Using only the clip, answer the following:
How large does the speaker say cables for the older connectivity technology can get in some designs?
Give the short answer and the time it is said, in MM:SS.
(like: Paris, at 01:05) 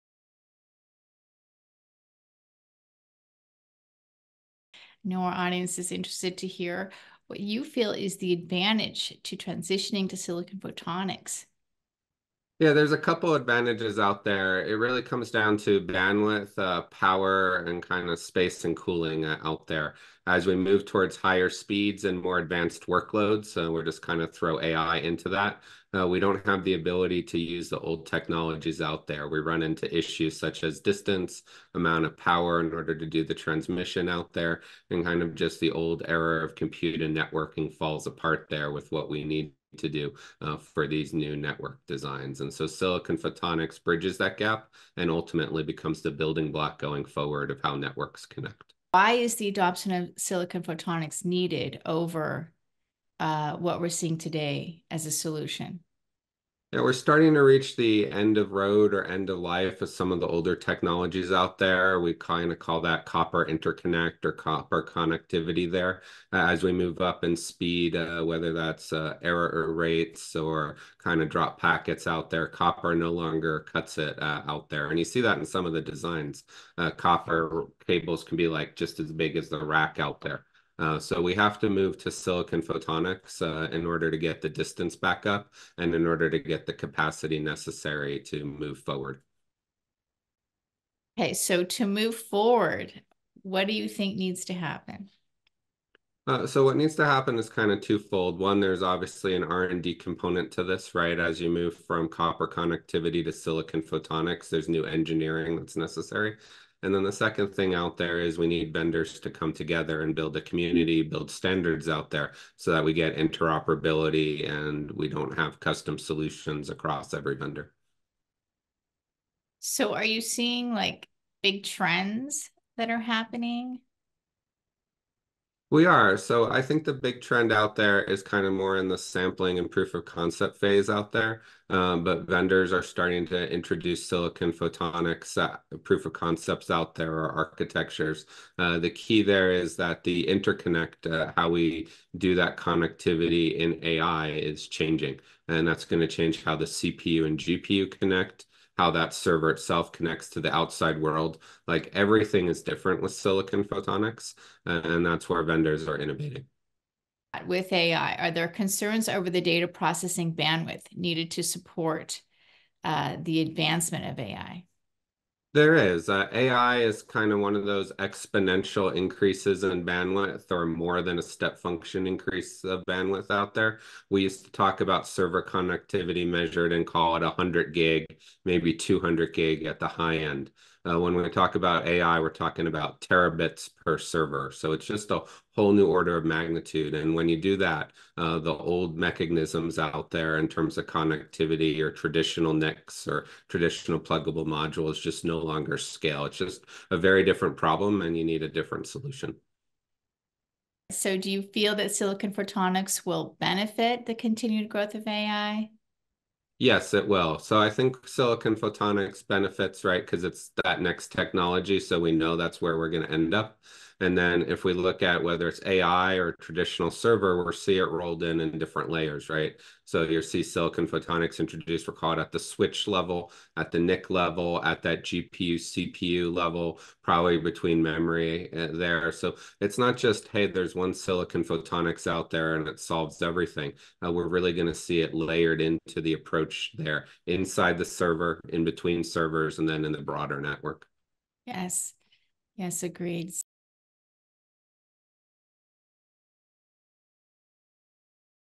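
As big as the rack, at 01:19.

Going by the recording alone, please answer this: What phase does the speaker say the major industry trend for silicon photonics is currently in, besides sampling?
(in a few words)
Proof of concept.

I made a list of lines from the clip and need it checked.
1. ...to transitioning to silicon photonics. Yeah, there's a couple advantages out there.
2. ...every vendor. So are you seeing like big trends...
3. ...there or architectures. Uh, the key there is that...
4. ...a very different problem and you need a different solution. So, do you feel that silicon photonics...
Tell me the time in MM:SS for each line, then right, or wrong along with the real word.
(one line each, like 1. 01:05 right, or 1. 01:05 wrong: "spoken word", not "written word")
1. 00:09 right
2. 01:57 right
3. 02:16 right
4. 03:16 right.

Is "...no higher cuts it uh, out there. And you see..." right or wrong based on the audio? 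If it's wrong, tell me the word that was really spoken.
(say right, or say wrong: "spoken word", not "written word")
wrong: "longer", not "higher".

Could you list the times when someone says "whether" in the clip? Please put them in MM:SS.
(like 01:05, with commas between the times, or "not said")
01:08, 03:35.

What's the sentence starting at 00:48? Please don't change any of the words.
Why is the adoption of silicon photonics needed over uh, what we're seeing today as a solution?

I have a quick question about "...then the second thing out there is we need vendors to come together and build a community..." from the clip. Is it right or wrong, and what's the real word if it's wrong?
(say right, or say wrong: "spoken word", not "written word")
right.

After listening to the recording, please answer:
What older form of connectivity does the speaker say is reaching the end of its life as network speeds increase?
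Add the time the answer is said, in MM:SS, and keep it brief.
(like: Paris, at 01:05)
Copper interconnect, at 01:03.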